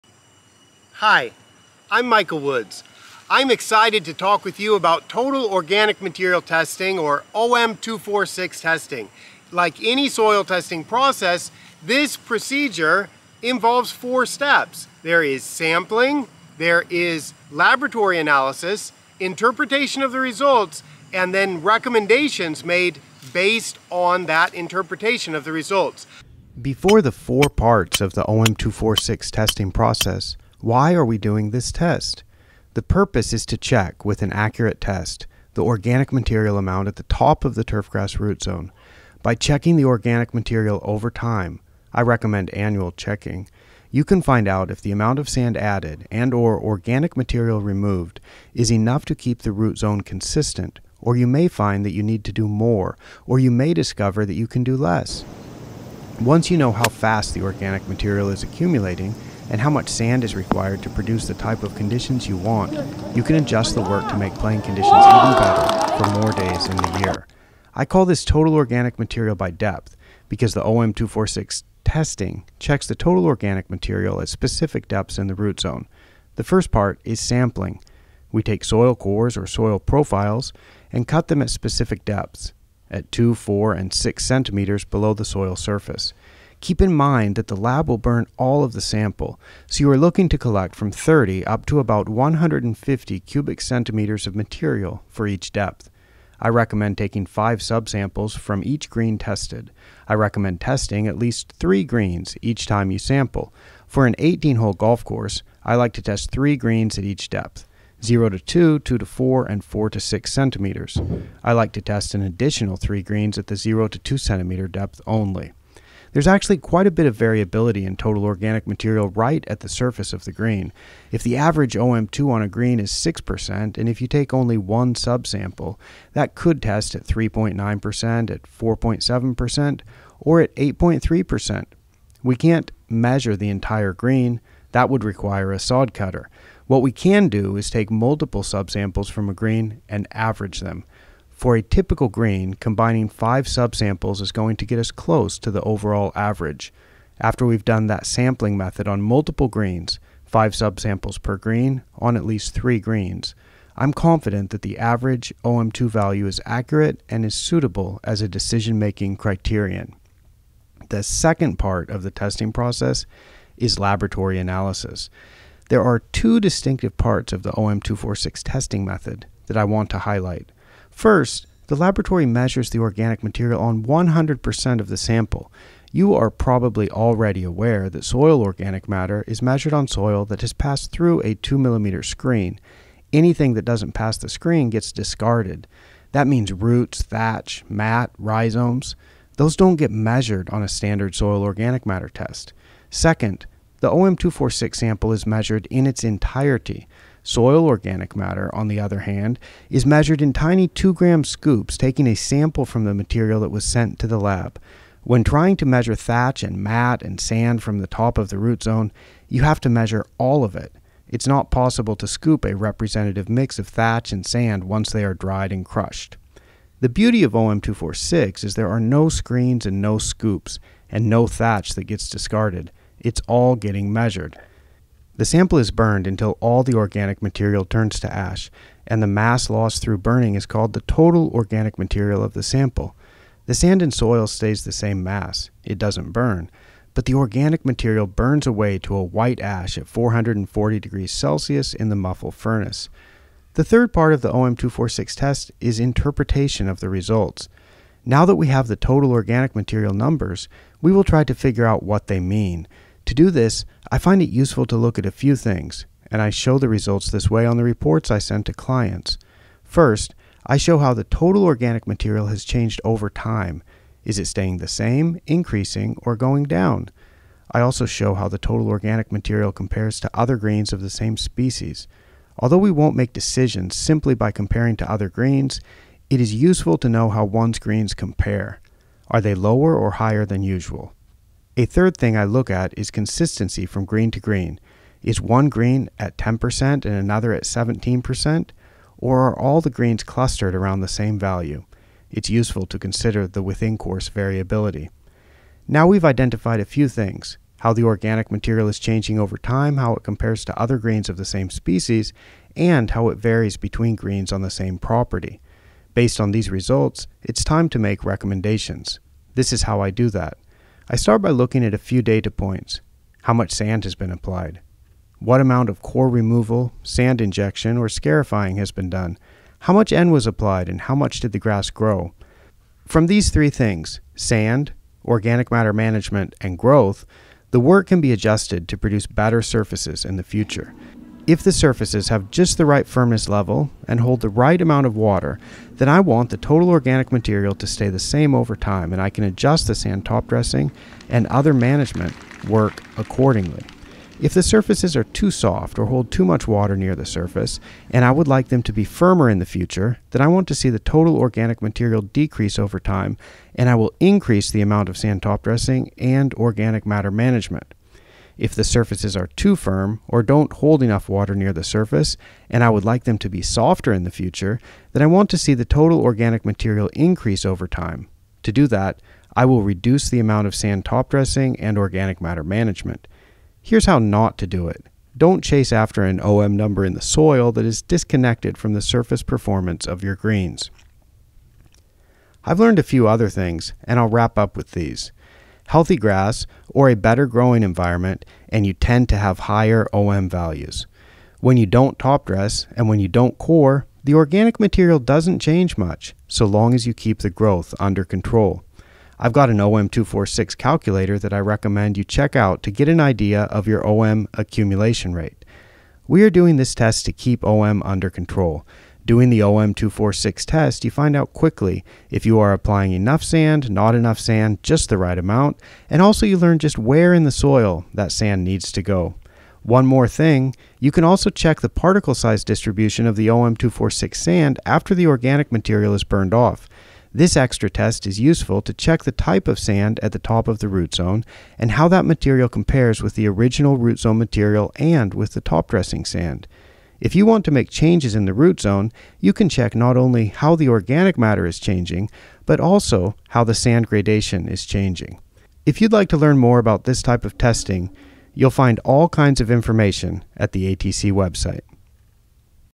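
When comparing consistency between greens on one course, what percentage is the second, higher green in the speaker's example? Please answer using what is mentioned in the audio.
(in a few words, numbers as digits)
17%.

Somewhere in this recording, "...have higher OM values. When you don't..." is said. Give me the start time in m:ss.
6:29.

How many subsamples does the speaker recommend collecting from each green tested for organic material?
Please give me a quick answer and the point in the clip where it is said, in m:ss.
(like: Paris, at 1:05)
5, at 1:37.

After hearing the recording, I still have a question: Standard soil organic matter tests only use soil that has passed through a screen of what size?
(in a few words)
2 millimeter.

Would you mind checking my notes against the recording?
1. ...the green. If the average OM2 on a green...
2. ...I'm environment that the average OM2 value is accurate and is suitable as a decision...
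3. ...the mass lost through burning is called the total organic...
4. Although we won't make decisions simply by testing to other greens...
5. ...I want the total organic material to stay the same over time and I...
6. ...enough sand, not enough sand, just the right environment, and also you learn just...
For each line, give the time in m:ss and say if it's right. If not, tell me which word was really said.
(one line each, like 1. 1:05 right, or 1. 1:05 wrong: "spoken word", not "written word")
1. 2:00 right
2. 2:33 wrong: "confident", not "environment"
3. 3:49 right
4. 4:32 wrong: "comparing", not "testing"
5. 5:35 right
6. 6:52 wrong: "amount", not "environment".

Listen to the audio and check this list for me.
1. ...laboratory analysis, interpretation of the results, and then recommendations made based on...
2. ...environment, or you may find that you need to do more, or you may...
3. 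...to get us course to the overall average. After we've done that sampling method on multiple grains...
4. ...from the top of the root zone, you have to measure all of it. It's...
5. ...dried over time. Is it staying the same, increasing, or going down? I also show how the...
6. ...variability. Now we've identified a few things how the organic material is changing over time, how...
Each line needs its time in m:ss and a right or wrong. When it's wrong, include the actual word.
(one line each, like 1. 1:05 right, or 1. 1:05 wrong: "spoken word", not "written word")
1. 0:17 right
2. 0:50 wrong: "consistent", not "environment"
3. 2:24 wrong: "close", not "course"
4. 3:27 right
5. 4:22 wrong: "changed", not "dried"
6. 4:54 right.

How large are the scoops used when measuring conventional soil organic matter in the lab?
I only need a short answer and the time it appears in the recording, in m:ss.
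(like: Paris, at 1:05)
2 grams, at 3:20.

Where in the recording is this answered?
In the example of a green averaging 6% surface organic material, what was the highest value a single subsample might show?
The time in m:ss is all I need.
2:10.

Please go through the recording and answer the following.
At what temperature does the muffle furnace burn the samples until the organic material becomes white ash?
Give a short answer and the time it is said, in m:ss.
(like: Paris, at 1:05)
440 degrees Celsius, at 3:59.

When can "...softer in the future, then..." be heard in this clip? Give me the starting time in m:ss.
6:03.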